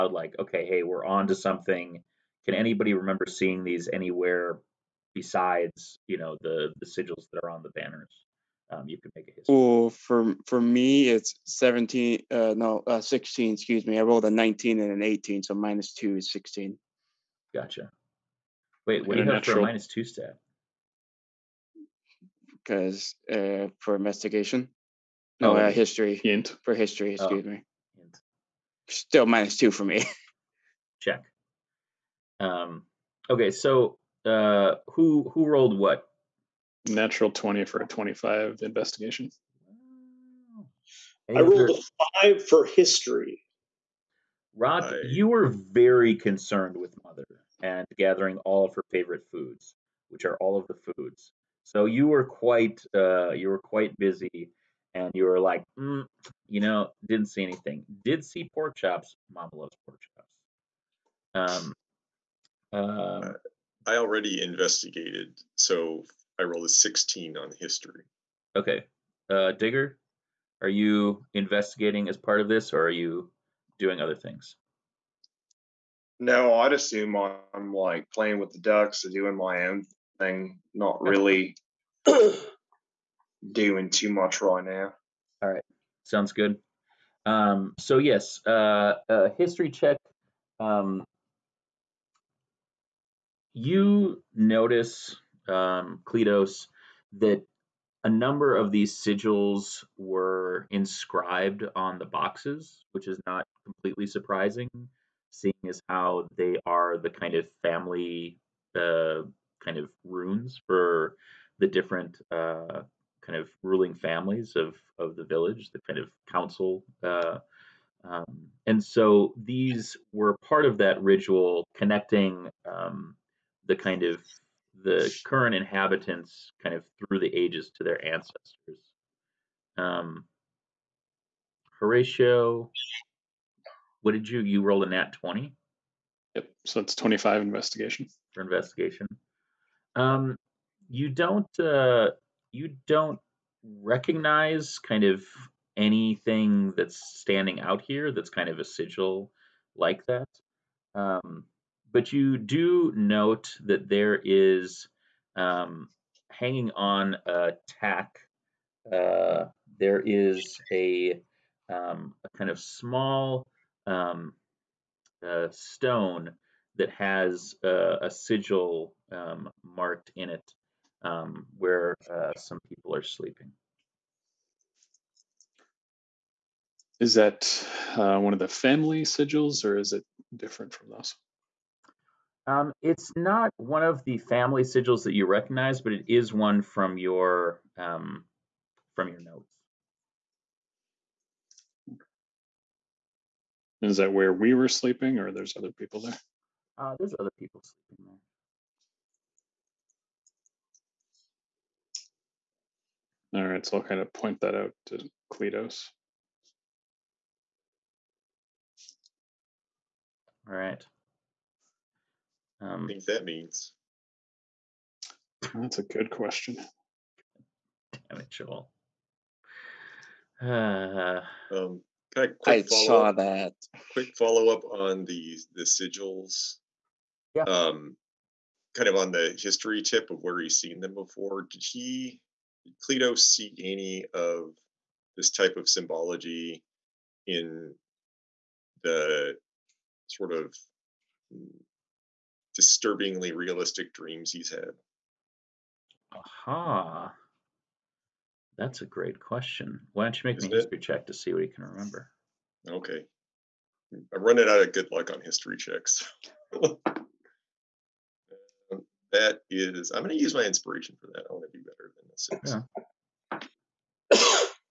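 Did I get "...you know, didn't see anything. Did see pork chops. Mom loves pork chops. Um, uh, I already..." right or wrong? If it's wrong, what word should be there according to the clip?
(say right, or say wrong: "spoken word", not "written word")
right.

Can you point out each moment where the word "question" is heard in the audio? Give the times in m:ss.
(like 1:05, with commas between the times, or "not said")
3:36, 4:09.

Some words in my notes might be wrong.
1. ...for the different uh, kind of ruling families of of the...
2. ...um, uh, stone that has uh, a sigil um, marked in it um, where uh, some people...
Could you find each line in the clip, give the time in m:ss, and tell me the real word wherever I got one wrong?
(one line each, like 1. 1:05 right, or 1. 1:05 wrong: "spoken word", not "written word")
1. 1:50 right
2. 2:43 right.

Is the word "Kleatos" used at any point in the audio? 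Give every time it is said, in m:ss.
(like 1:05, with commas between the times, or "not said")
1:36, 3:25.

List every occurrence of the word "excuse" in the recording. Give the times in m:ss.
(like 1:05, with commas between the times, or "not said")
0:13, 0:27.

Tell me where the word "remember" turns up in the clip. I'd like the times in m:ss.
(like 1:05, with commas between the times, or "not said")
0:02, 4:11.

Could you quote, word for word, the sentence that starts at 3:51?
Did he, did Cleto, see any of this type of symbology in the sort of disturbingly realistic dreams he's had?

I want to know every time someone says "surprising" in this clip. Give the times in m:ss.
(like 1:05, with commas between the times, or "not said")
1:44.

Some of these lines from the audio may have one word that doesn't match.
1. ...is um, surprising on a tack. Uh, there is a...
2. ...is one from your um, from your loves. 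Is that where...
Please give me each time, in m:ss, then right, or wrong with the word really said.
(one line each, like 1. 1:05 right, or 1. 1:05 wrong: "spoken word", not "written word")
1. 2:34 wrong: "hanging", not "surprising"
2. 3:06 wrong: "notes", not "loves".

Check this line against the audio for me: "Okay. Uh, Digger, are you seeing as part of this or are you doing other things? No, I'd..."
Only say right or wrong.
wrong.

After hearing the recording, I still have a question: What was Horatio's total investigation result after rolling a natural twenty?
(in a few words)
25.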